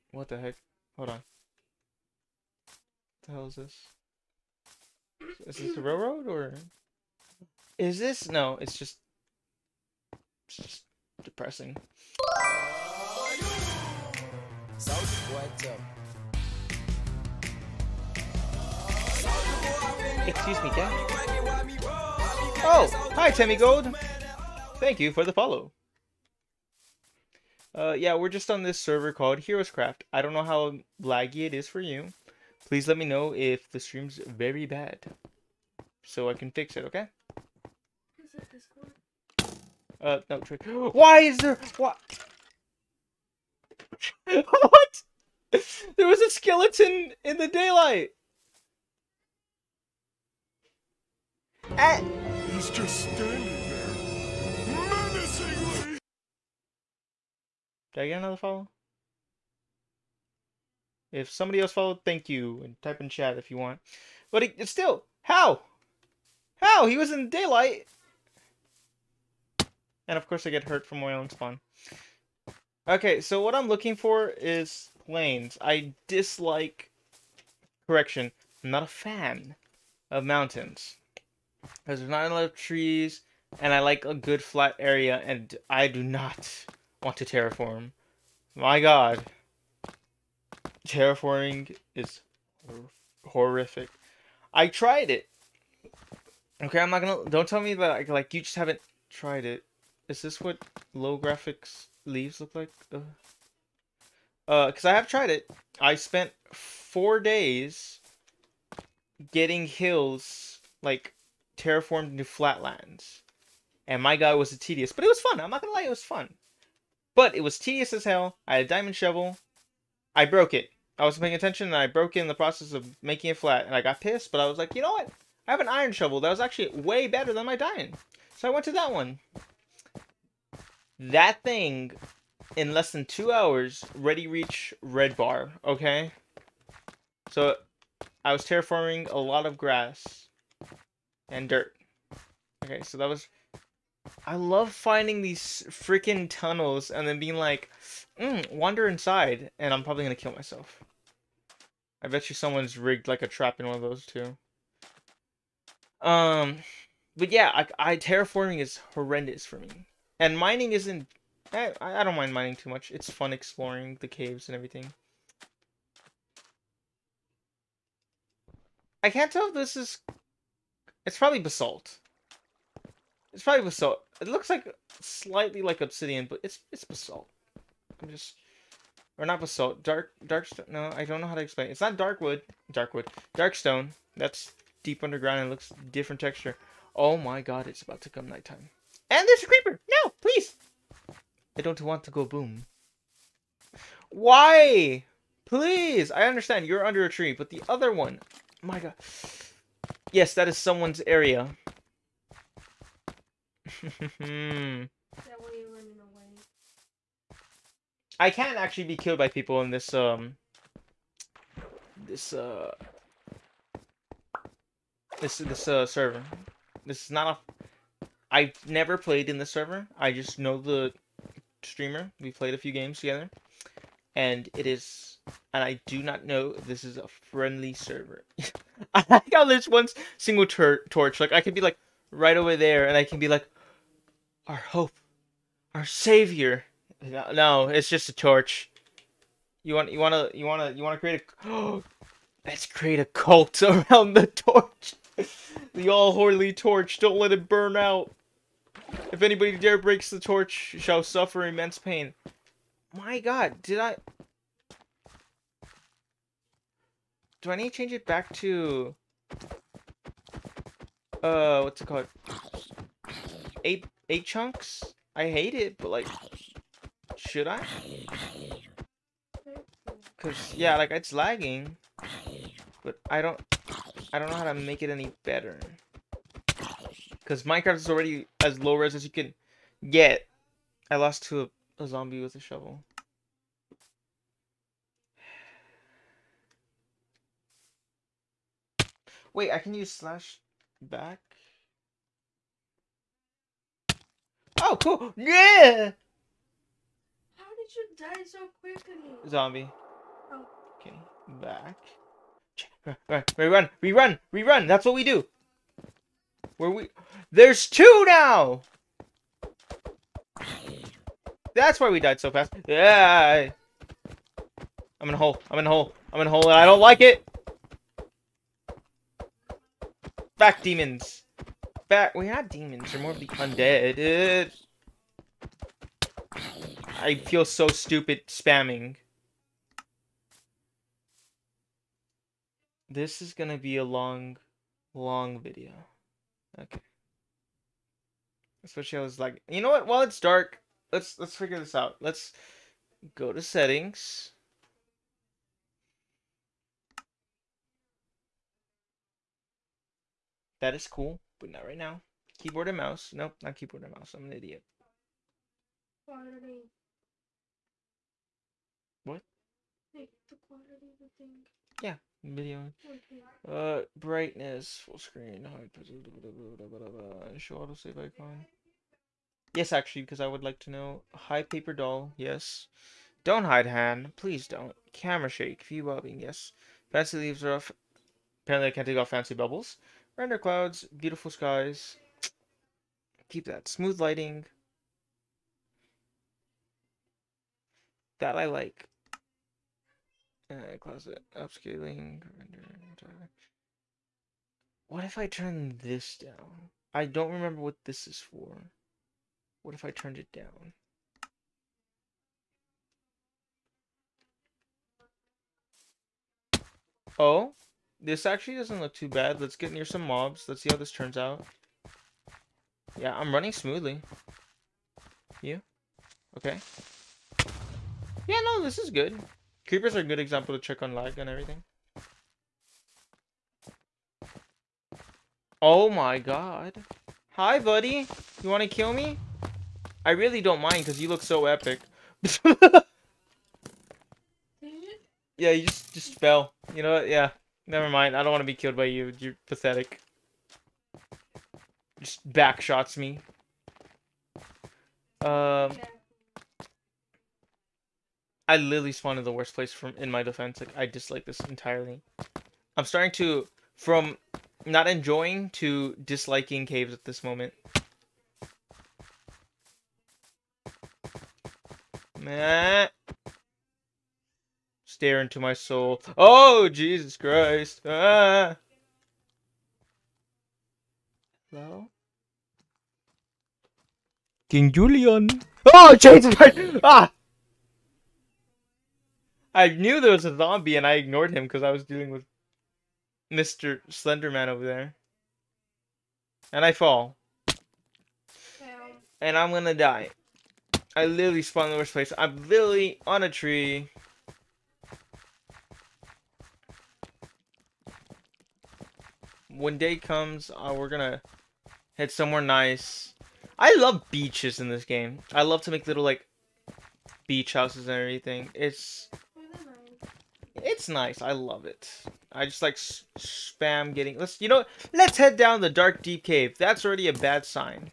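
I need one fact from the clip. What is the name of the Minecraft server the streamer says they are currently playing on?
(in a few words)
Heroescraft.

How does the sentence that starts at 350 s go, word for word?
That is cool, but not right now.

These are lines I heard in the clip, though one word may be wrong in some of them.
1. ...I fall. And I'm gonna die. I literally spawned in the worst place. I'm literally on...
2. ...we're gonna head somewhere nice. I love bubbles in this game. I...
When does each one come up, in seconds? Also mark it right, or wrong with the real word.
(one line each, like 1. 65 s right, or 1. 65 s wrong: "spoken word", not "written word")
1. 486 s right
2. 500 s wrong: "beaches", not "bubbles".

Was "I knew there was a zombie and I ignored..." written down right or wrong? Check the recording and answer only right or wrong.
right.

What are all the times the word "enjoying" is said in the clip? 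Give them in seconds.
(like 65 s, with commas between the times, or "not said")
454 s.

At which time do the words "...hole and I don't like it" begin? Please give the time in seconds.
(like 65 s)
316 s.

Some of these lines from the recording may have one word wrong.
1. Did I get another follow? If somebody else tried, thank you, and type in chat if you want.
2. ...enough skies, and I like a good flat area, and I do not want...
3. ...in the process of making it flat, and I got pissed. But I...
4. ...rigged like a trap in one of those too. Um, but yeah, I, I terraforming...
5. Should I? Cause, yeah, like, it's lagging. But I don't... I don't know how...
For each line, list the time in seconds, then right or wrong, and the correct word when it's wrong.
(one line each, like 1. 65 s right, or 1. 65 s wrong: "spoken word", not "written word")
1. 57 s wrong: "followed", not "tried"
2. 82 s wrong: "trees", not "skies"
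3. 122 s right
4. 152 s right
5. 267 s right.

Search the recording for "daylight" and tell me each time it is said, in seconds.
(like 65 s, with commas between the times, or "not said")
47 s, 67 s.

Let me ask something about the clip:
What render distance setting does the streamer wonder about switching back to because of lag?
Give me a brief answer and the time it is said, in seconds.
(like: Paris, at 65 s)
8 chunks, at 263 s.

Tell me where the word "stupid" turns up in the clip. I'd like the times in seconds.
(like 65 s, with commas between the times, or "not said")
327 s.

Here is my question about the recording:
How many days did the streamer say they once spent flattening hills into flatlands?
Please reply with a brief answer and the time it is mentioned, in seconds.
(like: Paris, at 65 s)
4, at 106 s.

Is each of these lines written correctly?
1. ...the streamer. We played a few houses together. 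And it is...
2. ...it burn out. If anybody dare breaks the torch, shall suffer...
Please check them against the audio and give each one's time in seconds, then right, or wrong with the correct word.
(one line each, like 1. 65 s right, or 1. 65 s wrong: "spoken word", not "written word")
1. 220 s wrong: "games", not "houses"
2. 247 s right.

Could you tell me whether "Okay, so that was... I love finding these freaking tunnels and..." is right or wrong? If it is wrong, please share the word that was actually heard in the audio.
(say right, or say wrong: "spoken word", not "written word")
right.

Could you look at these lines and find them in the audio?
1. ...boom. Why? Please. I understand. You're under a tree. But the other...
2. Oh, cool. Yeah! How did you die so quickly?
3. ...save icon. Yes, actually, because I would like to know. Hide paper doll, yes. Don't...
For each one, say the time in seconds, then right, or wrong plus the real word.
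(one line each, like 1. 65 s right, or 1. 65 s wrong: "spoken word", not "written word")
1. 192 s right
2. 294 s right
3. 367 s right.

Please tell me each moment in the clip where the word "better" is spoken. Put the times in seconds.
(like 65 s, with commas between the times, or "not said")
127 s, 275 s.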